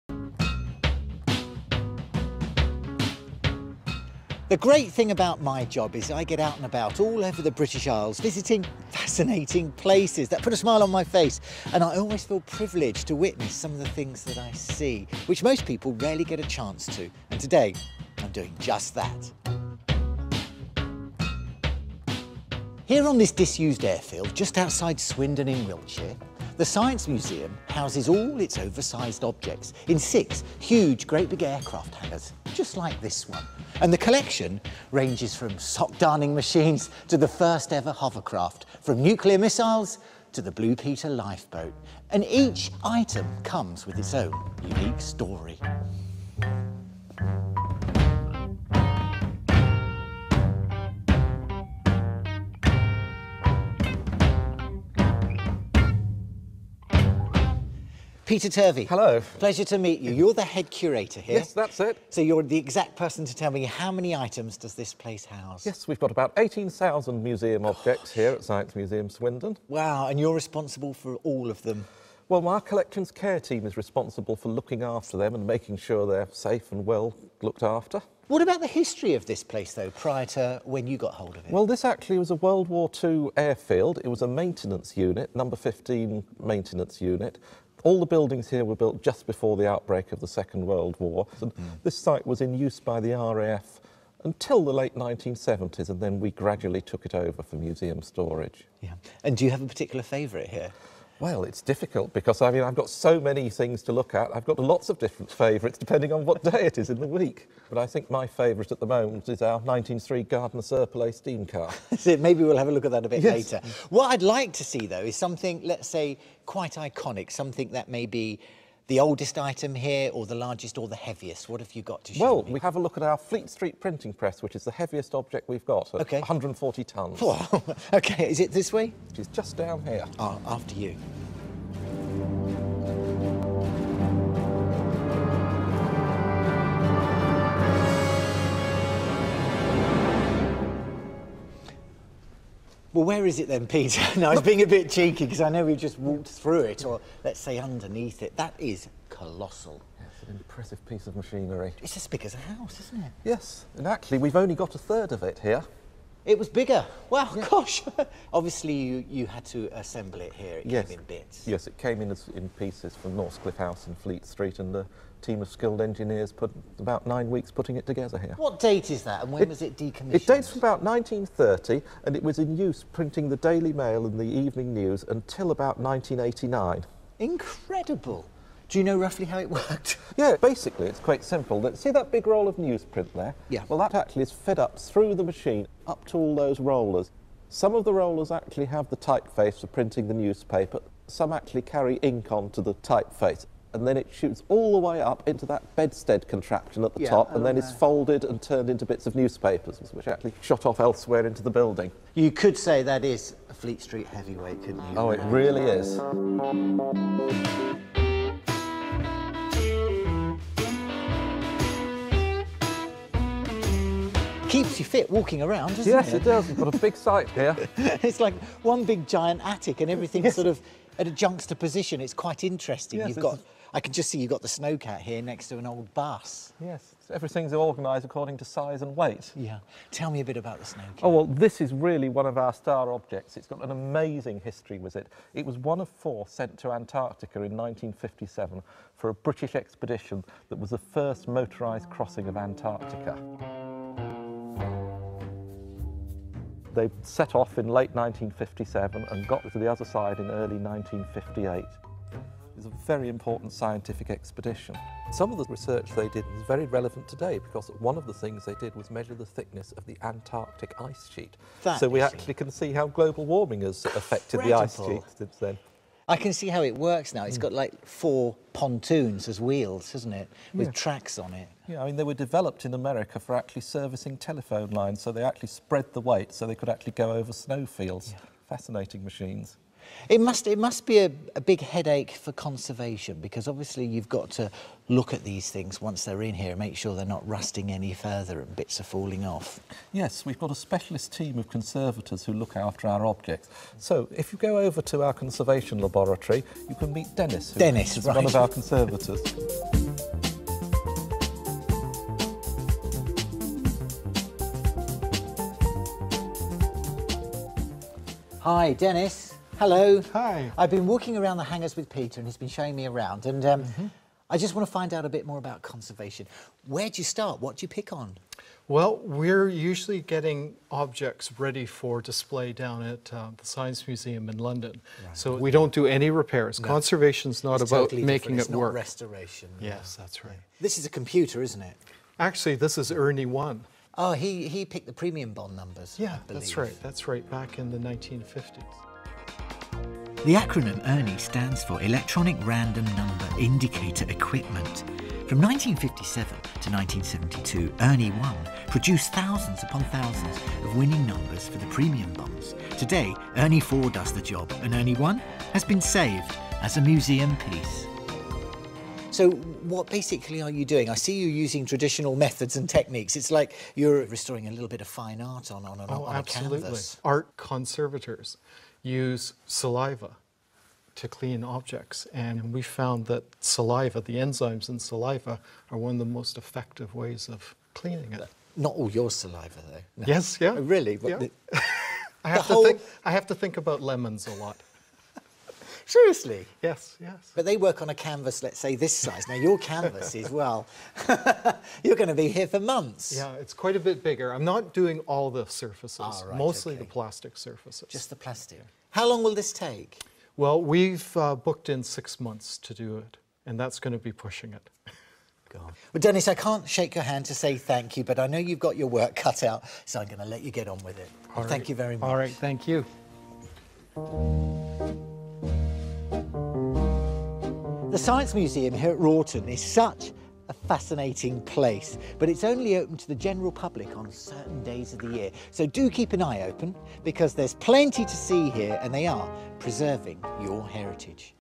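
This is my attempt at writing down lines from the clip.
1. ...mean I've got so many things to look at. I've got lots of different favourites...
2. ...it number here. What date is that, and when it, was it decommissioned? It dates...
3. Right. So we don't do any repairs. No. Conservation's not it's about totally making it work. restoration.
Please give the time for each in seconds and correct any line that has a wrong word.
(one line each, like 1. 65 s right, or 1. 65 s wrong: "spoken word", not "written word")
1. 102 s right
2. 167 s wrong: "together", not "number"
3. 324 s right.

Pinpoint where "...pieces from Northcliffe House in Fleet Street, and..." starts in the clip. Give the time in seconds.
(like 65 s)
162 s.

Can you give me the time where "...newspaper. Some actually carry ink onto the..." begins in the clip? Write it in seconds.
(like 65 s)
190 s.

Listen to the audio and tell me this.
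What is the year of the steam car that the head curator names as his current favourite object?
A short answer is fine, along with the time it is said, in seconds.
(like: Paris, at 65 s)
1903, at 109 s.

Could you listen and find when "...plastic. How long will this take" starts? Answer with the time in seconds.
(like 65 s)
398 s.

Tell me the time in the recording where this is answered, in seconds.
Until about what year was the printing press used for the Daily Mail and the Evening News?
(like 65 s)
175 s.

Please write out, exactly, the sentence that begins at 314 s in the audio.
I just want to find out a bit more about conservation.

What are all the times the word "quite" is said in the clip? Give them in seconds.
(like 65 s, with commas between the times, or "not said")
116 s, 180 s, 222 s, 393 s.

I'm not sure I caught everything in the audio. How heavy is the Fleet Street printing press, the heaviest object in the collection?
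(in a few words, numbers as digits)
140 tonnes.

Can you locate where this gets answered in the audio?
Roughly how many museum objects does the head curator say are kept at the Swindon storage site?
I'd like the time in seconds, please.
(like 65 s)
66 s.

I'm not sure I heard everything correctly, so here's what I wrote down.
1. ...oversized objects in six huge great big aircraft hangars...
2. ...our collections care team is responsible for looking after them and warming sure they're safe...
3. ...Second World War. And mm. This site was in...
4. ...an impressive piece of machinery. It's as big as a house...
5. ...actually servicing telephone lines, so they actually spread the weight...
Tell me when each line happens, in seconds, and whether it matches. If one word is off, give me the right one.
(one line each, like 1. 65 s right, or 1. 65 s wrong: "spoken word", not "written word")
1. 28 s right
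2. 72 s wrong: "making", not "warming"
3. 90 s right
4. 150 s right
5. 273 s right.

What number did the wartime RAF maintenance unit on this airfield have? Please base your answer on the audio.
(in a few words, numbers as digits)
15.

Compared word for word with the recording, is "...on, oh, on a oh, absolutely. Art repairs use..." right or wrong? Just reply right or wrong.
wrong.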